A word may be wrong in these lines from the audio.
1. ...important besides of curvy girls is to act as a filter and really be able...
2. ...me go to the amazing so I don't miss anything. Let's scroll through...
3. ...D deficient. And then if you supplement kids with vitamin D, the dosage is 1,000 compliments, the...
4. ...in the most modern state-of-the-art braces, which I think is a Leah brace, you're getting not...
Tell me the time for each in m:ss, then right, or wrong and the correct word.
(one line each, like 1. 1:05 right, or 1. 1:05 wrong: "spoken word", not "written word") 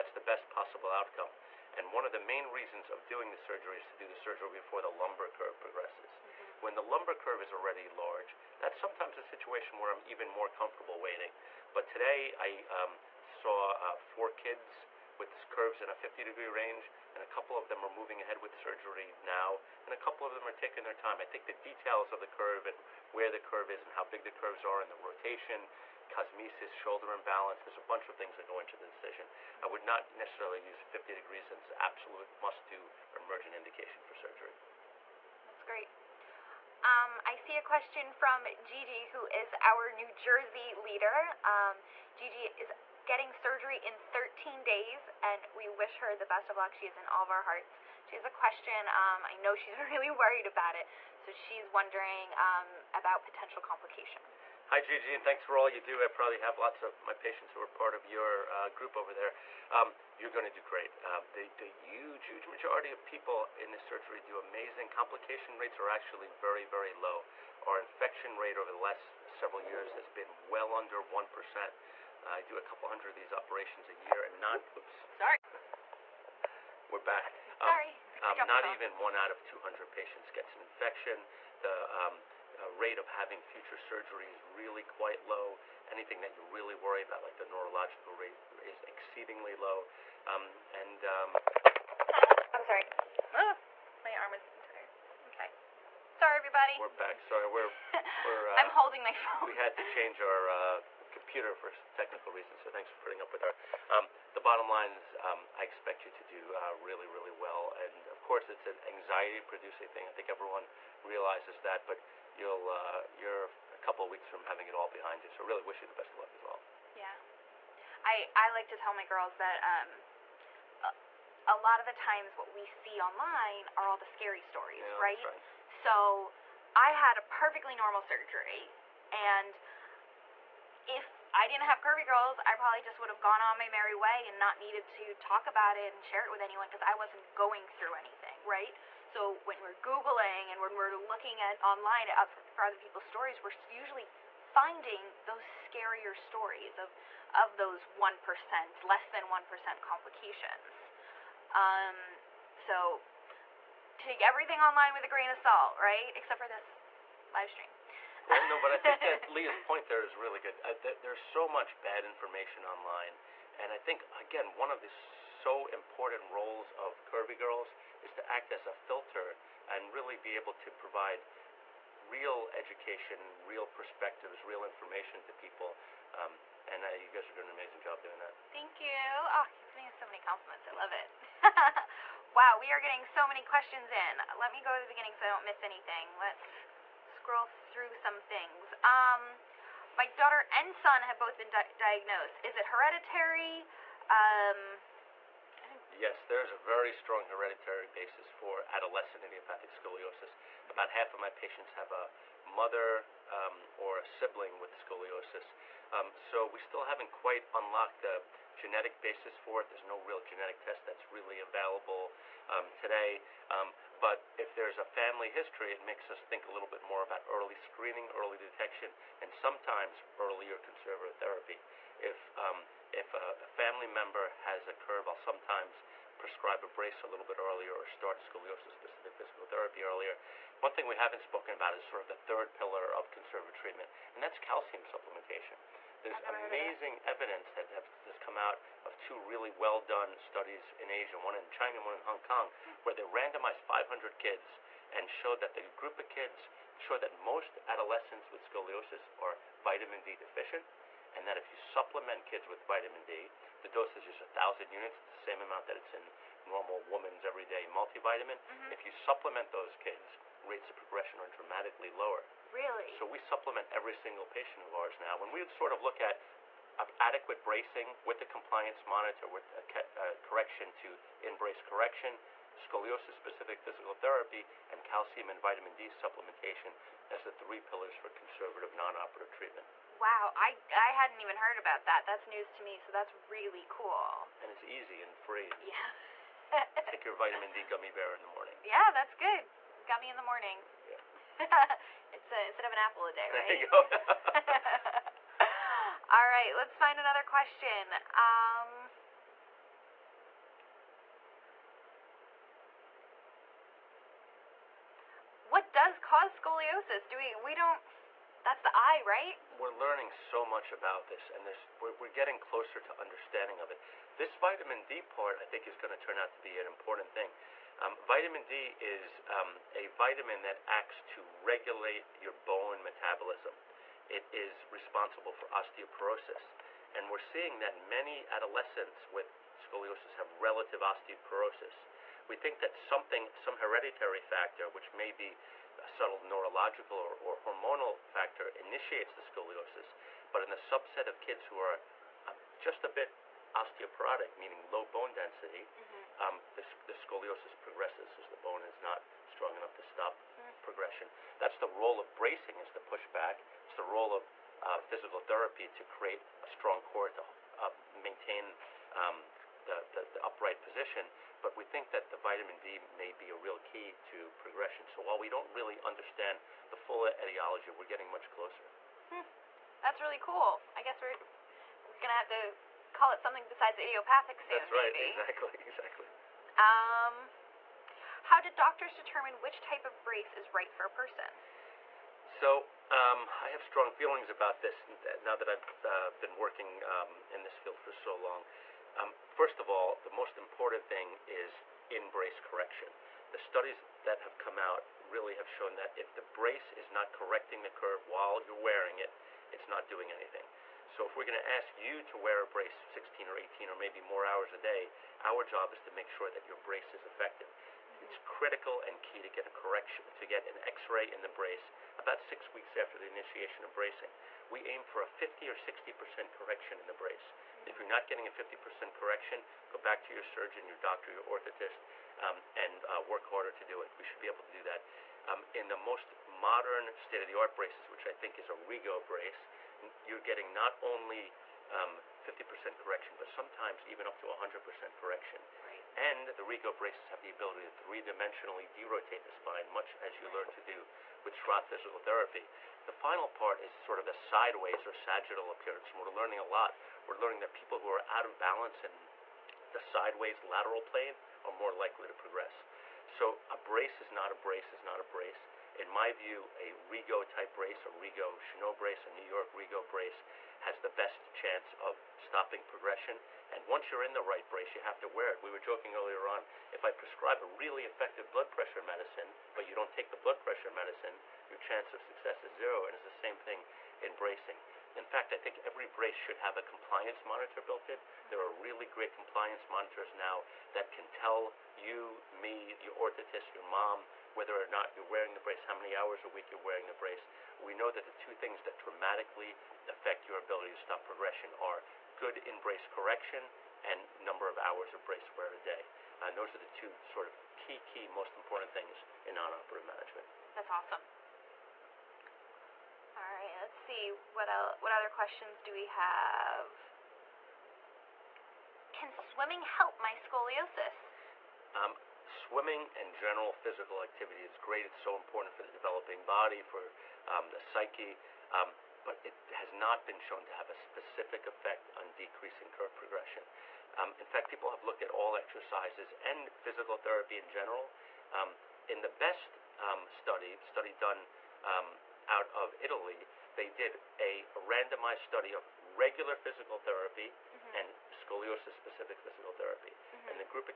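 1. 2:45 wrong: "roles", not "besides"
2. 3:04 wrong: "beginning", not "amazing"
3. 4:10 wrong: "units", not "compliments"
4. 7:05 wrong: "Rigo", not "Leah".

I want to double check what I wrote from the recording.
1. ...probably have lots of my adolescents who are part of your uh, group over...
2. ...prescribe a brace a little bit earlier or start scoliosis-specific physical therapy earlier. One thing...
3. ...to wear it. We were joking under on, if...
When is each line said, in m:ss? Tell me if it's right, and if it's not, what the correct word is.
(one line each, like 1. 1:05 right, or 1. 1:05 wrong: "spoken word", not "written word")
1. 0:56 wrong: "patients", not "adolescents"
2. 3:46 right
3. 7:45 wrong: "earlier", not "under".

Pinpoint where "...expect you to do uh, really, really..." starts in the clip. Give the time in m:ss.
1:45.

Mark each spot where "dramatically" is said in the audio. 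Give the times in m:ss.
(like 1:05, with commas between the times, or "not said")
4:21, 8:08.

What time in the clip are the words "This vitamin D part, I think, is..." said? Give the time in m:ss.
5:14.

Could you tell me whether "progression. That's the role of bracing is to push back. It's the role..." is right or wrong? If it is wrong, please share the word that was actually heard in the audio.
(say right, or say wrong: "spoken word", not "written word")
right.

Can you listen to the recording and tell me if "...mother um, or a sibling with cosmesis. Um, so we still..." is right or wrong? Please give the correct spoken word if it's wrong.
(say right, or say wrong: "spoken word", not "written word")
wrong: "scoliosis", not "cosmesis".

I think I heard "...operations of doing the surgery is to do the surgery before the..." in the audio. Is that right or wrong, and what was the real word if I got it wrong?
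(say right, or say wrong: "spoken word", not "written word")
wrong: "reasons", not "operations".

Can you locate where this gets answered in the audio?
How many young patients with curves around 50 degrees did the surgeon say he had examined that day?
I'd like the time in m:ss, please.
0:13.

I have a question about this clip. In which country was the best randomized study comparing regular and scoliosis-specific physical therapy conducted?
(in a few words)
Italy.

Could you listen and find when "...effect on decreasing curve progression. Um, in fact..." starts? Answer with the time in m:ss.
8:41.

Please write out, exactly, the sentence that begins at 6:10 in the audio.
I guess we're, we're going to have to call it something besides idiopathic soon.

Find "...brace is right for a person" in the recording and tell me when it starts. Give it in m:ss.
6:20.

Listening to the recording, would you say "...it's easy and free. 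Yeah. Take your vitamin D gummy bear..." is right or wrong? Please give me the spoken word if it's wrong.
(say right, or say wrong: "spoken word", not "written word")
right.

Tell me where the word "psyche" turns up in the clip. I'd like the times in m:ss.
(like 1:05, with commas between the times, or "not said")
8:37.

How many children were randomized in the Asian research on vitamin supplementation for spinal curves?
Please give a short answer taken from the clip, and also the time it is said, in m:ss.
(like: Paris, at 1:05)
500, at 4:03.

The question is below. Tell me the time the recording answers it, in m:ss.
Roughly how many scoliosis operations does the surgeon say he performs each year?
1:12.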